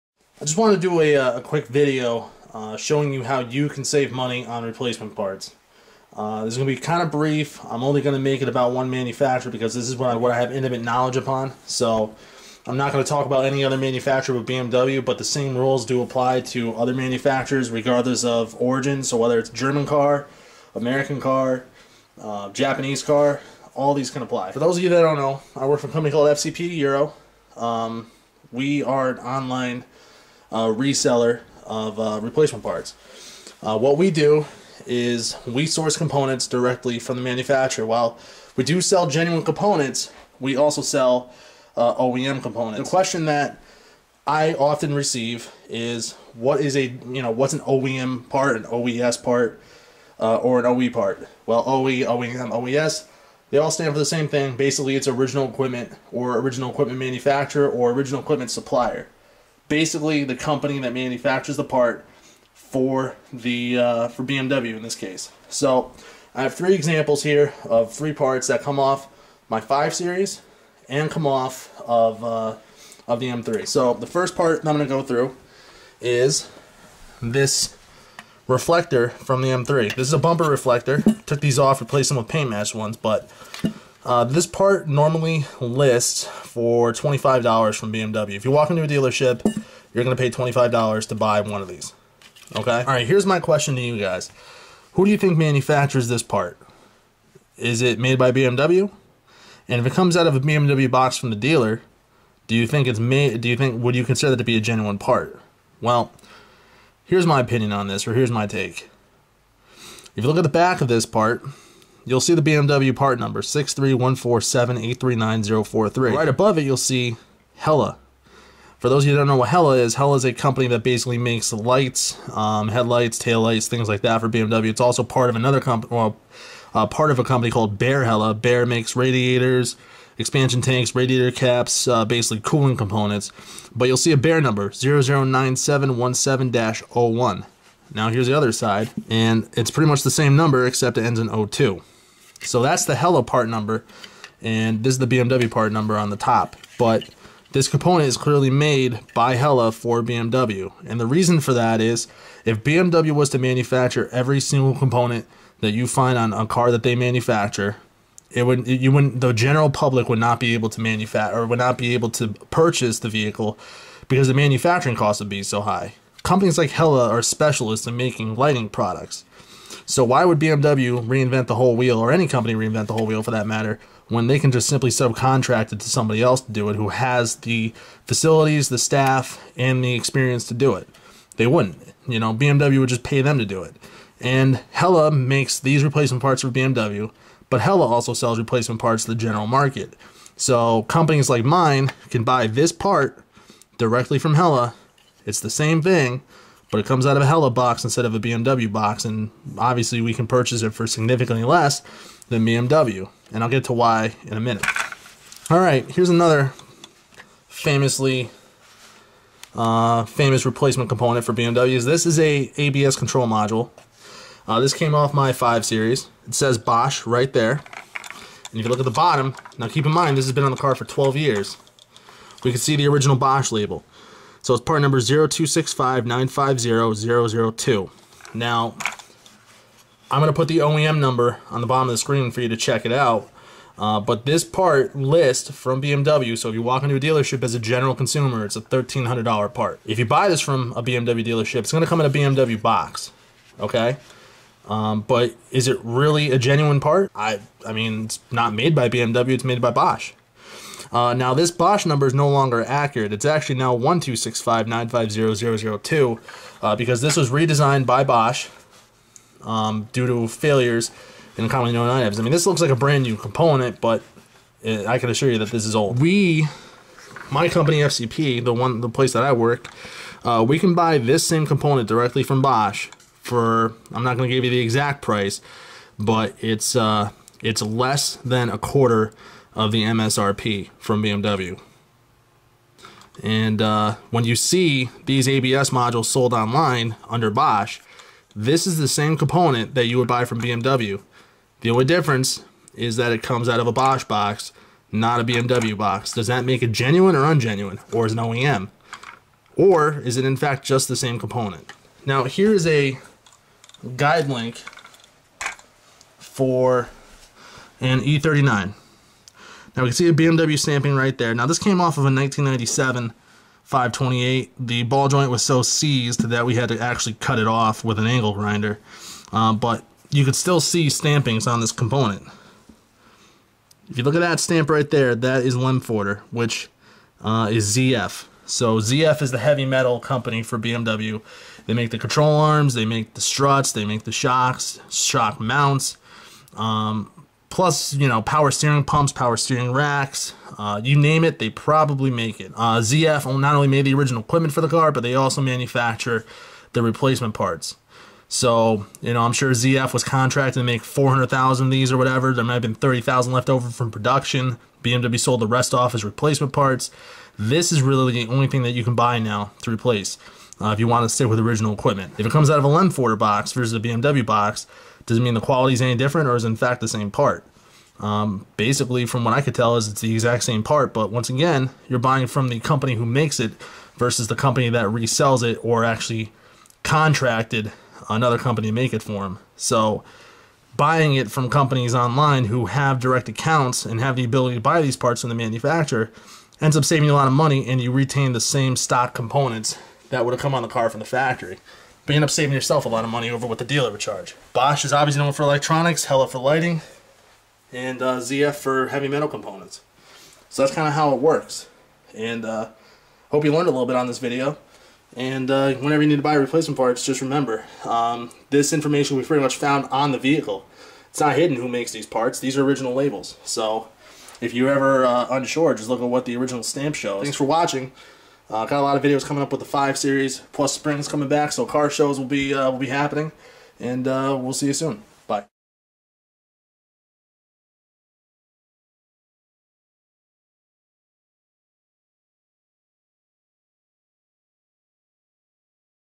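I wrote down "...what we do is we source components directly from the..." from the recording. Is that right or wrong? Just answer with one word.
right.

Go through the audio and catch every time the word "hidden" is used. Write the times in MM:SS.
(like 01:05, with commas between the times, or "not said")
06:51.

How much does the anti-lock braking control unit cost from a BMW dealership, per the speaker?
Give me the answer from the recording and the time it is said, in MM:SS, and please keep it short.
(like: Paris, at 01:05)
$1,300, at 03:58.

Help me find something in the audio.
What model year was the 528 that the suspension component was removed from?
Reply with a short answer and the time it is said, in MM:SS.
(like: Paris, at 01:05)
1997, at 05:12.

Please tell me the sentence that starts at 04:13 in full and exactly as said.
It's actually now 1265950002 uh, because this was redesigned by Bosch um, due to failures in commonly known items.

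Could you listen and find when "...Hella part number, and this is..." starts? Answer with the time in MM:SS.
02:22.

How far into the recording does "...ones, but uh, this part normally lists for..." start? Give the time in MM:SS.
01:22.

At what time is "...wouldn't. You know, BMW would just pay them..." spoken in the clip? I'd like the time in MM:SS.
03:01.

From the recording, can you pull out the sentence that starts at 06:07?
Um, basically, from what I could tell, is it's the exact same part.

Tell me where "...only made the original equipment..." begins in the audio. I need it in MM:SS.
05:43.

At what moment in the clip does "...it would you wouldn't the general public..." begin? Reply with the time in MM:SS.
02:38.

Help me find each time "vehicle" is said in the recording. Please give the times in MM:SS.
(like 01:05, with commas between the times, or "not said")
02:43, 06:50.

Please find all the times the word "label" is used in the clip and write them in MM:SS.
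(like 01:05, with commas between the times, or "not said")
03:43, 06:52.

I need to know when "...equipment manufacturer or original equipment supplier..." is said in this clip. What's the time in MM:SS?
00:56.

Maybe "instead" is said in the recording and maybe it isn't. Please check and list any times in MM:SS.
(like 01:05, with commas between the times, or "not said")
03:17.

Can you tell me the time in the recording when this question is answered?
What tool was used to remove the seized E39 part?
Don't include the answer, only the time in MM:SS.
05:18.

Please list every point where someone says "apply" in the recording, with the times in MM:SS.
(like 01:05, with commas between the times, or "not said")
00:16, 00:24.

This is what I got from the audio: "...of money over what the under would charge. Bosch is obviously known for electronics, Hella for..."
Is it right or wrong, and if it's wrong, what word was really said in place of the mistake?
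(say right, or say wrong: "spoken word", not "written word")
wrong: "dealer", not "under".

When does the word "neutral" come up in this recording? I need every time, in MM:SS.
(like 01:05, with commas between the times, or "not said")
not said.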